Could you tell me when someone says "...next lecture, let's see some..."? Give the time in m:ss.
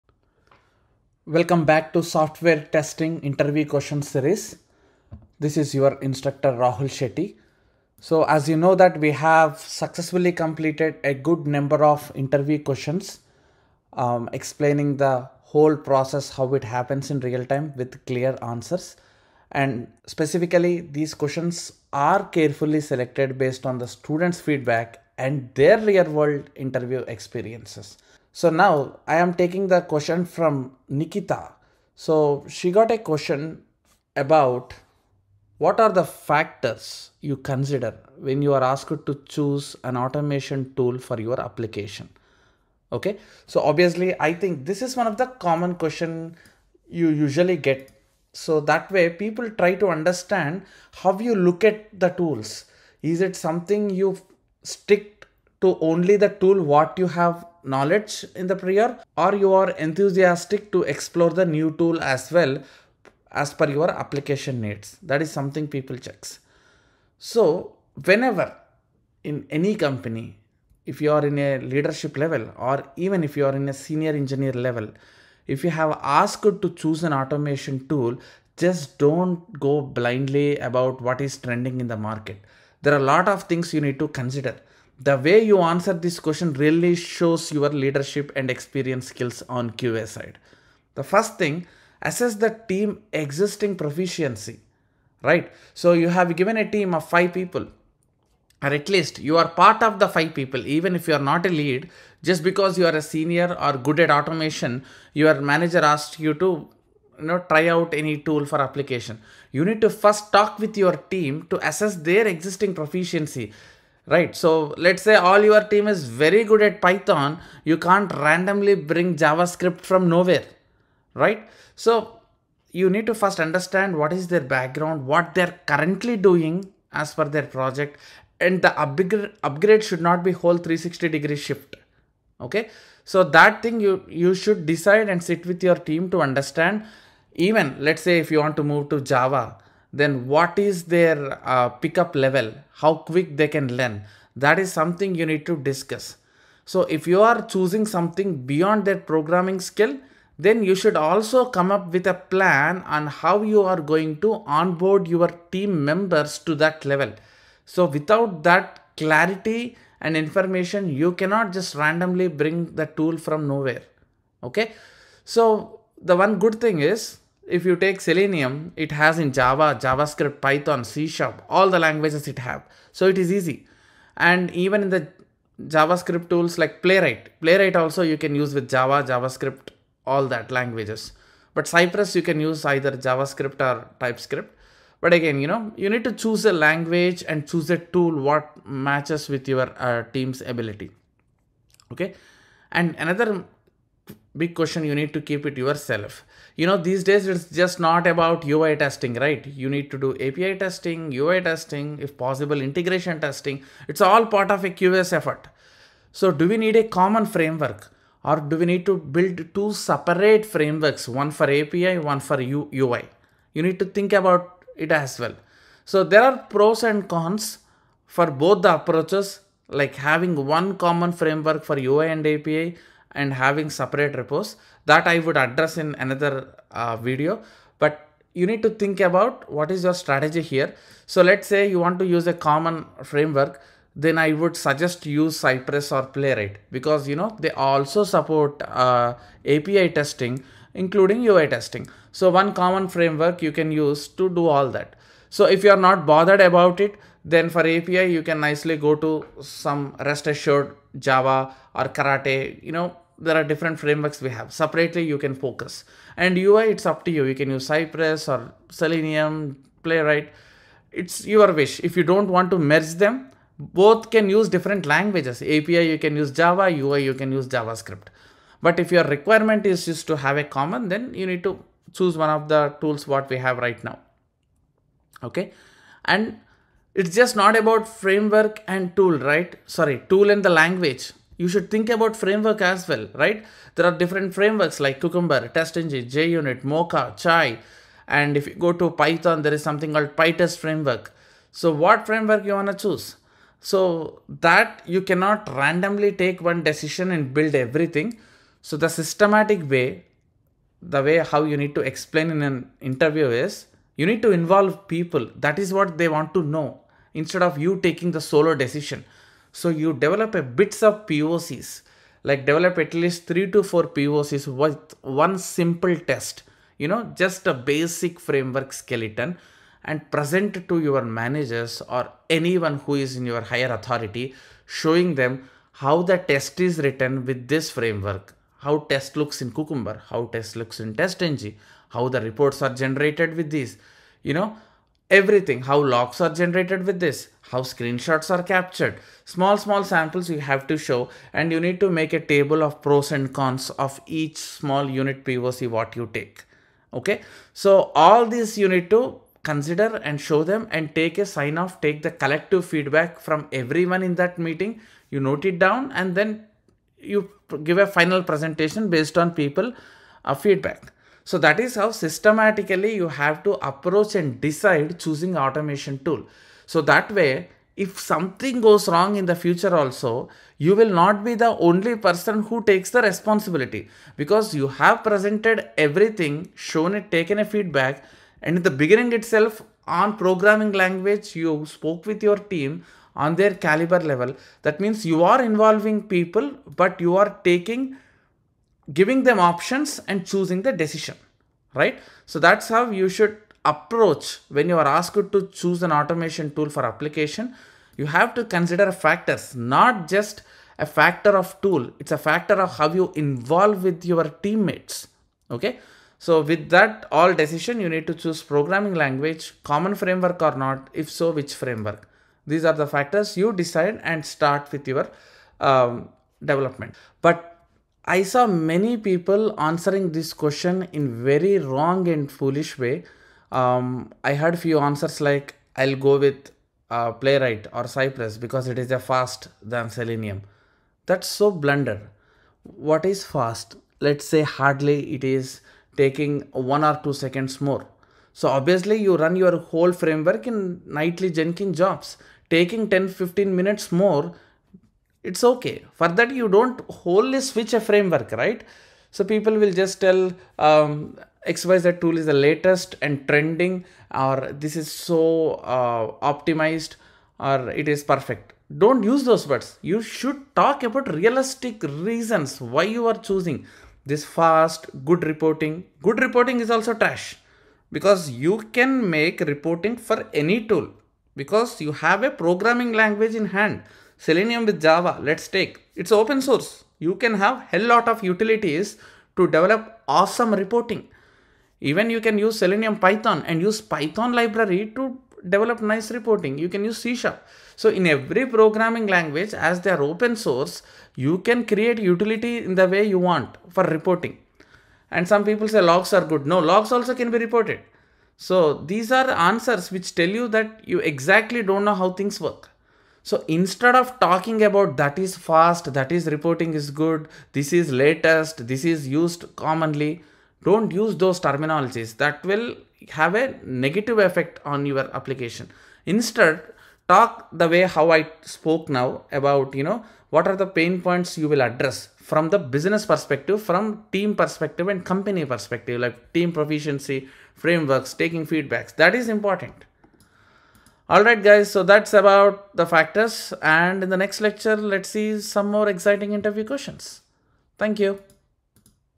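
8:54.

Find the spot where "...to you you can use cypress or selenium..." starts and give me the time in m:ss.
4:17.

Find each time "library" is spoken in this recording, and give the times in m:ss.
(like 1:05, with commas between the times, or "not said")
8:04.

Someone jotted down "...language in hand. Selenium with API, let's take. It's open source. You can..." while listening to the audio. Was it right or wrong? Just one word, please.
wrong.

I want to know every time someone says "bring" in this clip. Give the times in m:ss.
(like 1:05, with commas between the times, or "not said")
1:58, 2:42.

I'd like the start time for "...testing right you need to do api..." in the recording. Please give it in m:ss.
3:18.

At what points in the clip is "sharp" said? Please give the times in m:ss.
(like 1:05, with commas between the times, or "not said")
2:51, 8:07.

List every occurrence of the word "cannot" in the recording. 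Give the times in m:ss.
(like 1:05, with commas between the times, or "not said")
2:41, 4:55.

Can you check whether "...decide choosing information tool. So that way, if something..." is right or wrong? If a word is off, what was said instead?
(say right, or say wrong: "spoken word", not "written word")
wrong: "automation", not "information".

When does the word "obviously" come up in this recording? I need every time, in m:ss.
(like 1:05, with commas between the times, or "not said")
0:43, 7:18.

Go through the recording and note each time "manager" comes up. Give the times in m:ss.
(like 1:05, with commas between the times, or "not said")
1:45, 5:21.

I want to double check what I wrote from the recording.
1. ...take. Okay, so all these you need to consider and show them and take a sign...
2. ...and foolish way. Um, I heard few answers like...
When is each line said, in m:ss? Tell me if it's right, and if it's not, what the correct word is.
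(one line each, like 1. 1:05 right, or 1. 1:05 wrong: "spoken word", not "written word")
1. 5:46 right
2. 7:02 right.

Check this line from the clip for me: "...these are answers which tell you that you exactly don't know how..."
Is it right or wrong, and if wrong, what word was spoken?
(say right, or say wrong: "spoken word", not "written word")
right.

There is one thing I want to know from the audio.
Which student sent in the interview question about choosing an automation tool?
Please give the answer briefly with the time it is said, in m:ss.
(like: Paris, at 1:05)
Nikita, at 0:30.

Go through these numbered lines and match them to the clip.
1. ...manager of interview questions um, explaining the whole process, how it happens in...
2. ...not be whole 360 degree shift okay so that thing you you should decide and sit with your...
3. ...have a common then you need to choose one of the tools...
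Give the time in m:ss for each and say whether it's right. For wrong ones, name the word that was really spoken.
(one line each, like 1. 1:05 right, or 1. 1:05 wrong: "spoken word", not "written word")
1. 0:11 wrong: "number", not "manager"
2. 2:10 right
3. 4:30 right.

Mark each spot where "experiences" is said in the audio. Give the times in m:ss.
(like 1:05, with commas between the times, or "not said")
0:27, 1:28.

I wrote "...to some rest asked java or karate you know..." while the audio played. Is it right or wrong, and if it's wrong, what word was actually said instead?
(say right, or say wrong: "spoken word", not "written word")
wrong: "assured", not "asked".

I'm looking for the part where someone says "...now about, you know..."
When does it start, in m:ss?
8:38.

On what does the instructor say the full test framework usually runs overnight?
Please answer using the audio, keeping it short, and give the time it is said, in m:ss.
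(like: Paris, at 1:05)
Jenkins jobs, at 7:21.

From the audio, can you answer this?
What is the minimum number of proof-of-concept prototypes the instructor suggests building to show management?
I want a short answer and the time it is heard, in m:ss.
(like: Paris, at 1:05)
3 to 4, at 5:13.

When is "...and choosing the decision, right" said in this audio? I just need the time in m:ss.
6:30.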